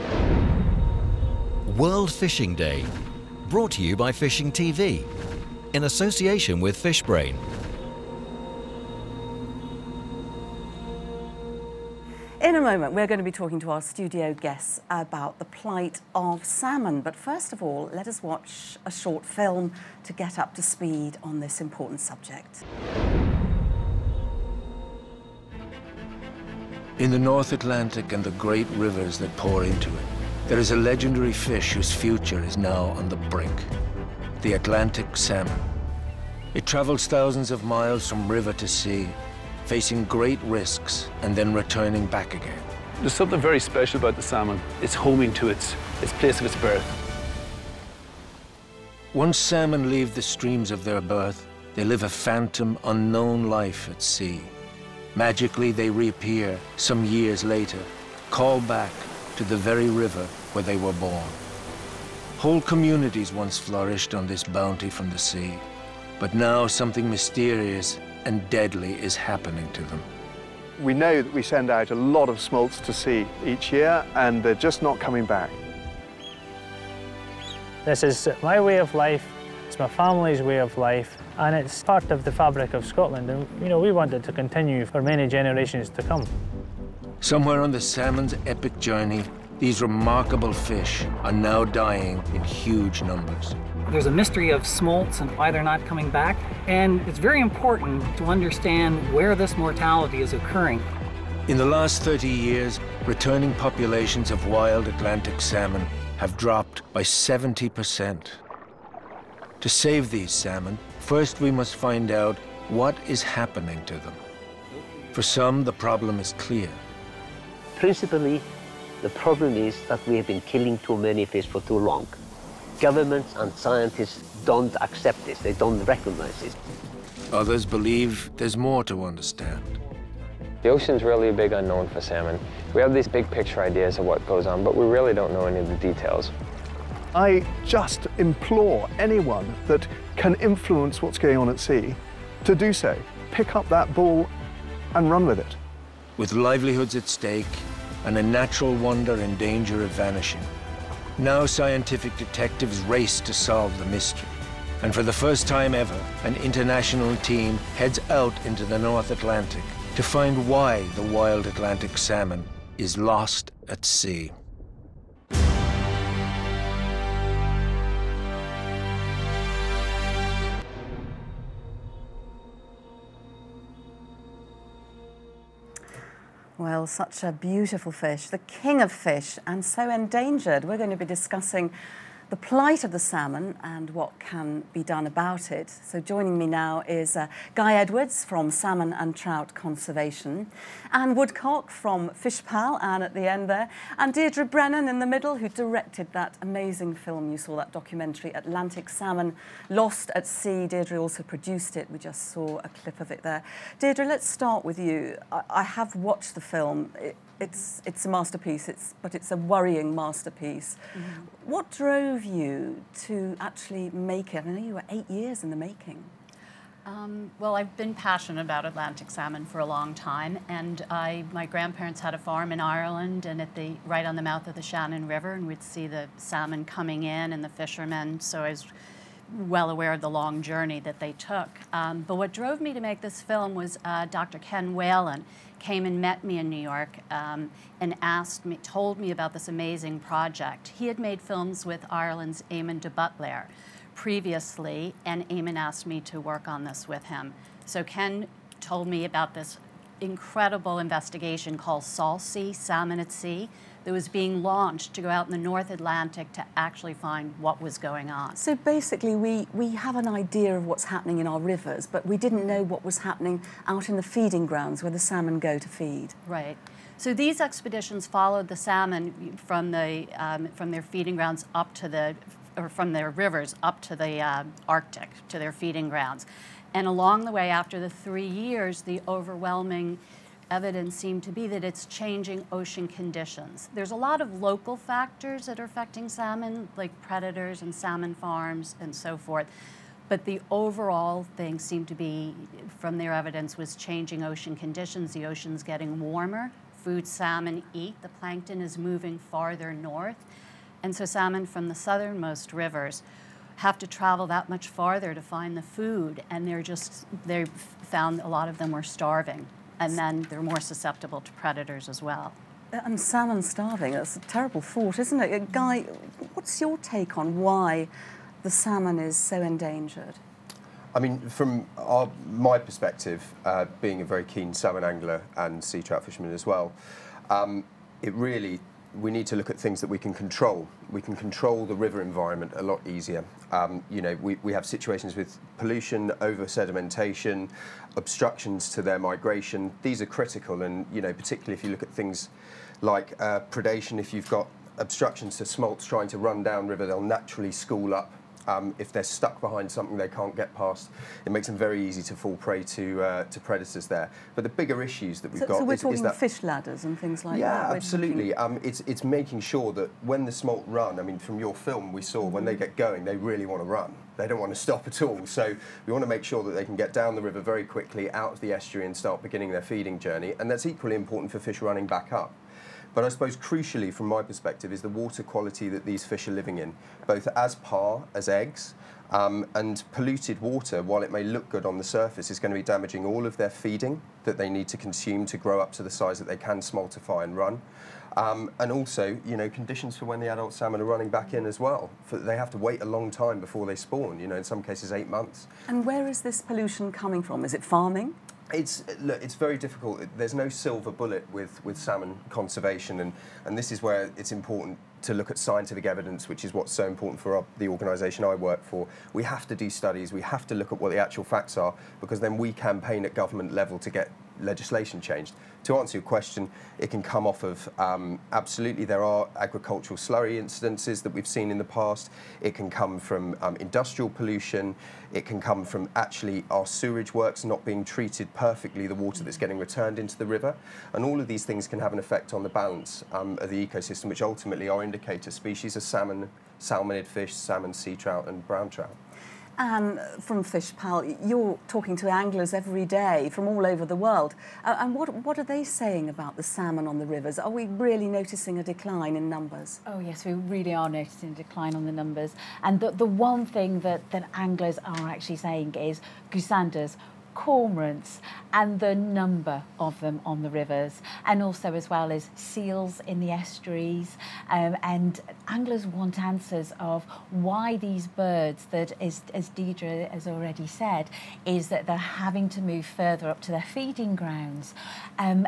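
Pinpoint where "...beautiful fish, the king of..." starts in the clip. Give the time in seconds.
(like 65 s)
177 s.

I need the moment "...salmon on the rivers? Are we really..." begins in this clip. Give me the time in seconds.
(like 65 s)
446 s.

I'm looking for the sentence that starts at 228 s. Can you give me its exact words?
So I was well aware of the long journey that they took.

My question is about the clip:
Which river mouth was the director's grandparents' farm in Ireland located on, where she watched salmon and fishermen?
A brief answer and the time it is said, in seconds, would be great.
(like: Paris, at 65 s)
Shannon River, at 224 s.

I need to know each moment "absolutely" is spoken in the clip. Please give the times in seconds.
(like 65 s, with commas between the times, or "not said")
357 s, 418 s.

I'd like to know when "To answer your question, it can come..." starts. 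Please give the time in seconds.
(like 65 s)
415 s.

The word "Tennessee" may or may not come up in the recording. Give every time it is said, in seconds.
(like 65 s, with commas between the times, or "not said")
not said.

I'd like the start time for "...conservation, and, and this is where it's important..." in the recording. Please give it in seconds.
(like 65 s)
402 s.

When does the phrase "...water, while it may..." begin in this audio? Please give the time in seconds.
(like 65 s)
380 s.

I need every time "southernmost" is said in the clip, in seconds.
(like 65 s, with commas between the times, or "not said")
301 s.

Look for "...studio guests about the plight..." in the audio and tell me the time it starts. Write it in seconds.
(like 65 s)
13 s.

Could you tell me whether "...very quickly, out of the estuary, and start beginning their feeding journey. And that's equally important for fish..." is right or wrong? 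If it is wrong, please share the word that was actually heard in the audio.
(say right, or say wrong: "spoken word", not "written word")
right.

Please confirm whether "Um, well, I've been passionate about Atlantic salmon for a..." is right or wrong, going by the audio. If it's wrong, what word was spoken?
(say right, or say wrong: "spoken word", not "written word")
right.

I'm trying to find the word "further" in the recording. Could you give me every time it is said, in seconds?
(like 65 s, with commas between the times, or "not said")
472 s.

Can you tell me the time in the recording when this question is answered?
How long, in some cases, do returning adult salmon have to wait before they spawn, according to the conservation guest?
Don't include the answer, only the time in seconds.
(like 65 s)
394 s.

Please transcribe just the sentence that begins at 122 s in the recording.
Governments and scientists don't accept this, they don't recognize it.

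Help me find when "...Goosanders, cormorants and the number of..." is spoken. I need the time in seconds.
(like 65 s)
456 s.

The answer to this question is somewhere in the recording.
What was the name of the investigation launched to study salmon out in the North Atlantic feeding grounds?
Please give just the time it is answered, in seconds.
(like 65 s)
251 s.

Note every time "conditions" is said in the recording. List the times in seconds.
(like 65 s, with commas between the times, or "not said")
282 s, 294 s, 389 s.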